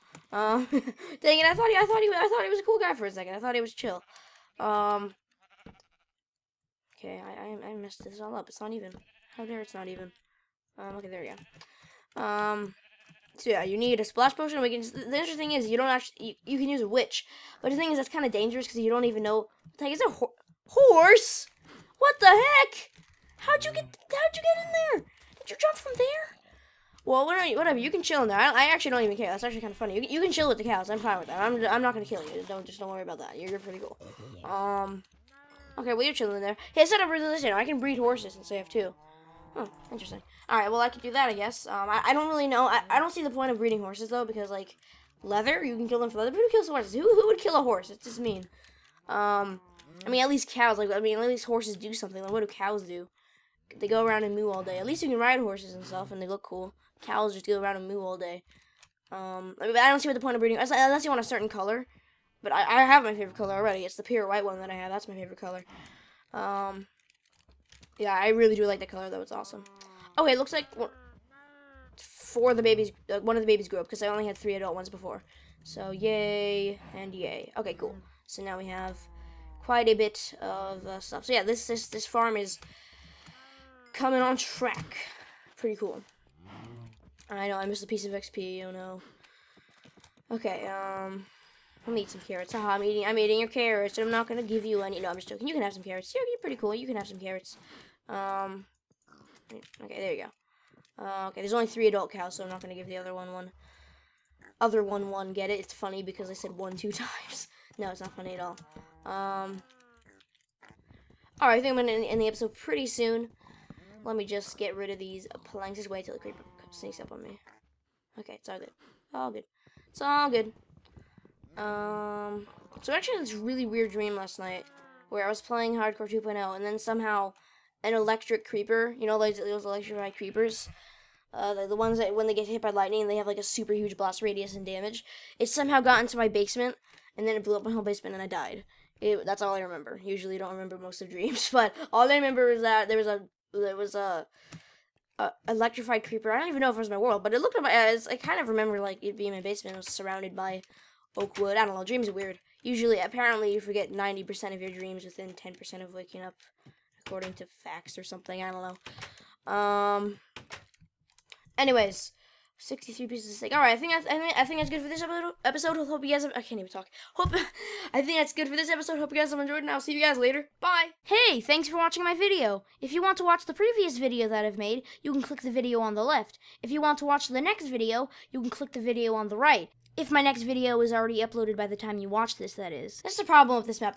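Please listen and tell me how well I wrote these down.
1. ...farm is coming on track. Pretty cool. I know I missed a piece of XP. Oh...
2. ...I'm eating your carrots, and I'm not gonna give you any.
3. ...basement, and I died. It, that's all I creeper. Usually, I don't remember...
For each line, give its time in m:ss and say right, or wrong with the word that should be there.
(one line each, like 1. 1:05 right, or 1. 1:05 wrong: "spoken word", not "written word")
1. 1:22 right
2. 1:33 right
3. 2:17 wrong: "remember", not "creeper".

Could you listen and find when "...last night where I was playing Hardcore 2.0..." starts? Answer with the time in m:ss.
2:04.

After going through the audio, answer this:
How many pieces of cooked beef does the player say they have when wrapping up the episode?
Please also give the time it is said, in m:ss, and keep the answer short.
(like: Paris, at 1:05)
63, at 2:42.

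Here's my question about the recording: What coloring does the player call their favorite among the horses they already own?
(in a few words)
pure white.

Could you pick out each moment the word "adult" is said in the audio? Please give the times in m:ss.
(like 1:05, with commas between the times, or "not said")
1:14, 1:41.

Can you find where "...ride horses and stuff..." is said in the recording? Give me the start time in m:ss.
0:55.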